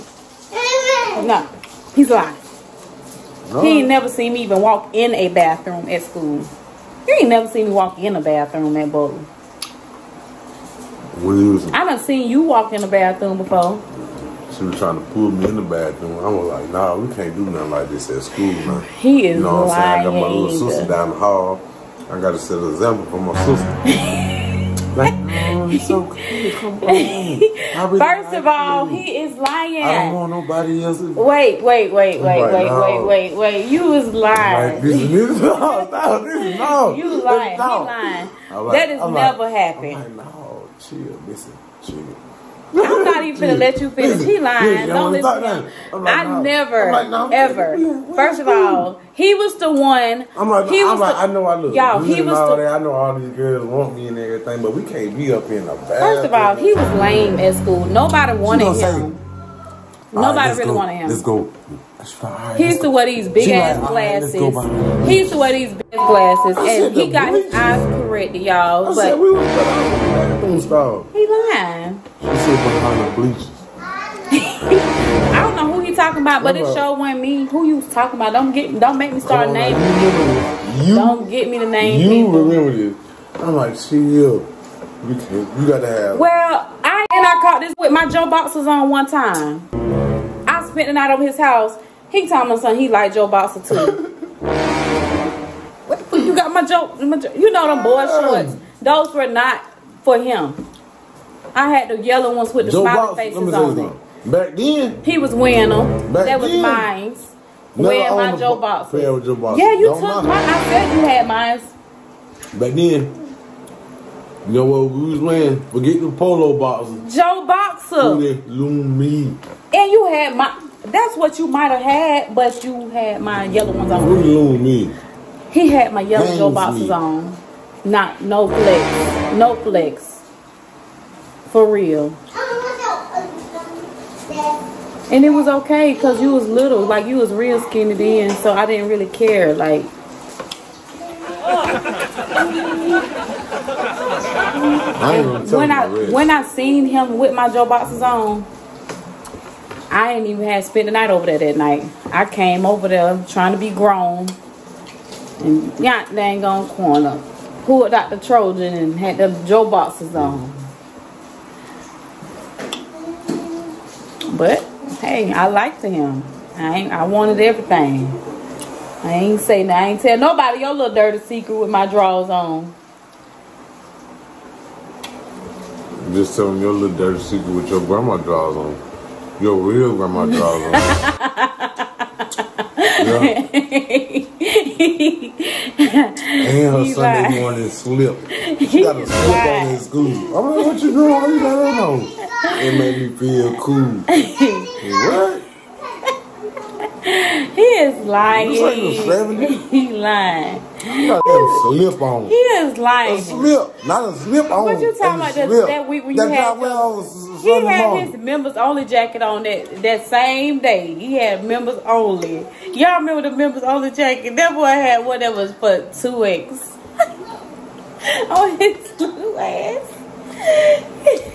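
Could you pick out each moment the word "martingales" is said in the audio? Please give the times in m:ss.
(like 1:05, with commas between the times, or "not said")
not said.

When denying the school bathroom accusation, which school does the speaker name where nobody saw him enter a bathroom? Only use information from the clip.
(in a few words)
Bowling.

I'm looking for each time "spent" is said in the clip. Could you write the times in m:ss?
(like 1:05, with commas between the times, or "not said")
1:30, 2:30.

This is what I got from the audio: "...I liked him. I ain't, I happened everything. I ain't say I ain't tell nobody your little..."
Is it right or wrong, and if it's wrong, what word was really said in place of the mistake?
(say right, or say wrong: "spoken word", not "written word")
wrong: "wanted", not "happened".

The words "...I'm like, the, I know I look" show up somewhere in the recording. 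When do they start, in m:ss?
0:50.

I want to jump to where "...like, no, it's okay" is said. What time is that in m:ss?
0:24.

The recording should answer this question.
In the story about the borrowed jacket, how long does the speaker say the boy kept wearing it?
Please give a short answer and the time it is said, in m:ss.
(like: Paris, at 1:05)
2 weeks, at 3:35.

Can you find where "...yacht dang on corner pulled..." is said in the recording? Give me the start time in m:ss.
2:35.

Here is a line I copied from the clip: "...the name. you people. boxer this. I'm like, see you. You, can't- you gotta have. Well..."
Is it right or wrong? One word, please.
wrong.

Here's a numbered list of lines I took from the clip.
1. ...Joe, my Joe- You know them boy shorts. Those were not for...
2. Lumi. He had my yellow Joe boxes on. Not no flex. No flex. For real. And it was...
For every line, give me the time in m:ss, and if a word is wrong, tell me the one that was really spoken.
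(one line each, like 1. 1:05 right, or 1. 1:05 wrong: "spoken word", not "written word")
1. 1:36 right
2. 2:04 right.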